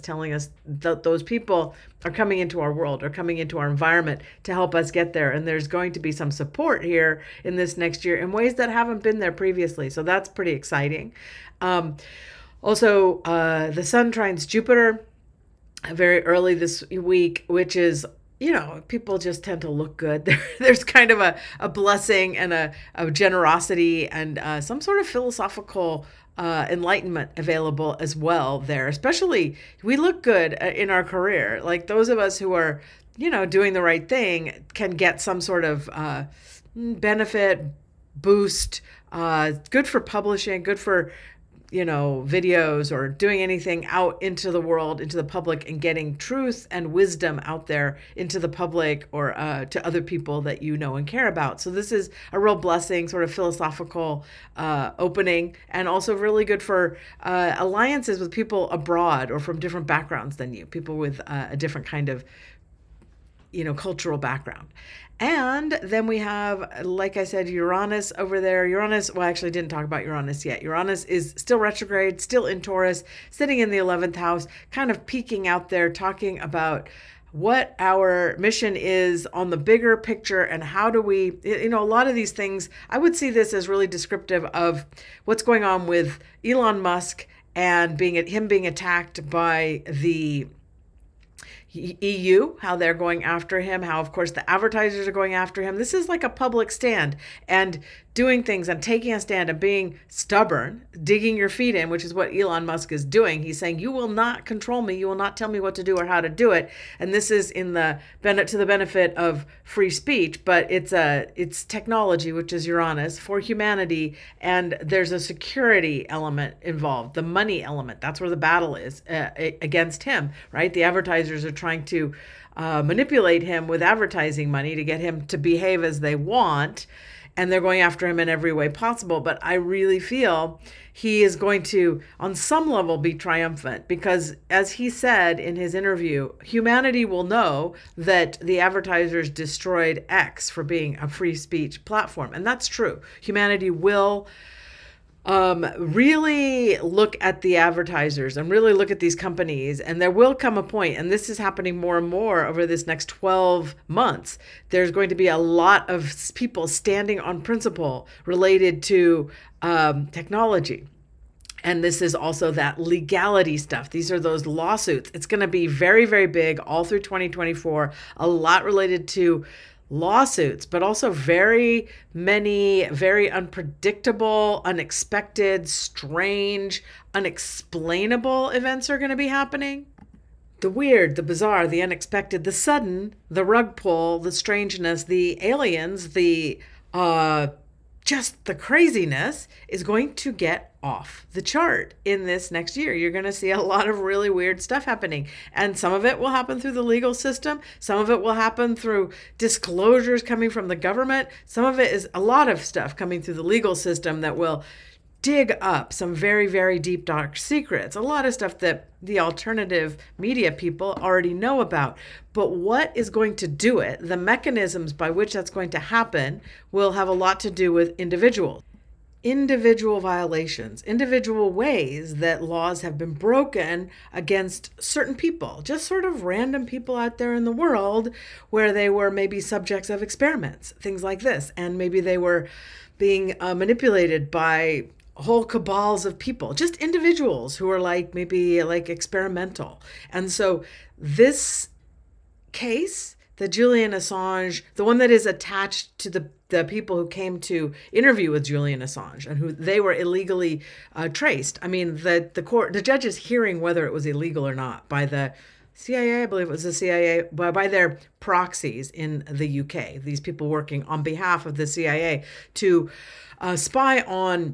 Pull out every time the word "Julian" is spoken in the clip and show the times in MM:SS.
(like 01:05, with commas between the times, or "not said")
04:03, 04:08.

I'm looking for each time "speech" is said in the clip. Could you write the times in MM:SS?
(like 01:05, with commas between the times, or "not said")
01:49, 02:21.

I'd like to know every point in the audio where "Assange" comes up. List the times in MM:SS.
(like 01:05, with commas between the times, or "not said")
04:03, 04:08.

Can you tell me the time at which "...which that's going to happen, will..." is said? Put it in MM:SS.
03:35.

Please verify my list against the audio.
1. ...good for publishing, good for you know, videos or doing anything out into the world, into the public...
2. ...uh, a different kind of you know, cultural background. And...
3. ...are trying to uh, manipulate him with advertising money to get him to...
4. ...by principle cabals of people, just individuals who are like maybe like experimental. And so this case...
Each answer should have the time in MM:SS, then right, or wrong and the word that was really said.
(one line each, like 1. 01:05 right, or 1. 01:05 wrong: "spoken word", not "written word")
1. 00:39 right
2. 01:01 right
3. 02:01 right
4. 03:54 wrong: "whole", not "principle".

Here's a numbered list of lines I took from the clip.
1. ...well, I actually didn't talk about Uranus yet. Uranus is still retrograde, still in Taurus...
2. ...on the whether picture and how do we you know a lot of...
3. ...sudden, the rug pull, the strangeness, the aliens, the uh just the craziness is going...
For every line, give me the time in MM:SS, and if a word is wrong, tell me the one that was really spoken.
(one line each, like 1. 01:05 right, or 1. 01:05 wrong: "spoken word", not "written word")
1. 01:09 right
2. 01:19 wrong: "bigger", not "whether"
3. 03:02 right.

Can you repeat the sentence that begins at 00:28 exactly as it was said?
Especially, we look good uh, in our career.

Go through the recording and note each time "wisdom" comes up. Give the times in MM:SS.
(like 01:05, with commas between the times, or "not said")
00:46.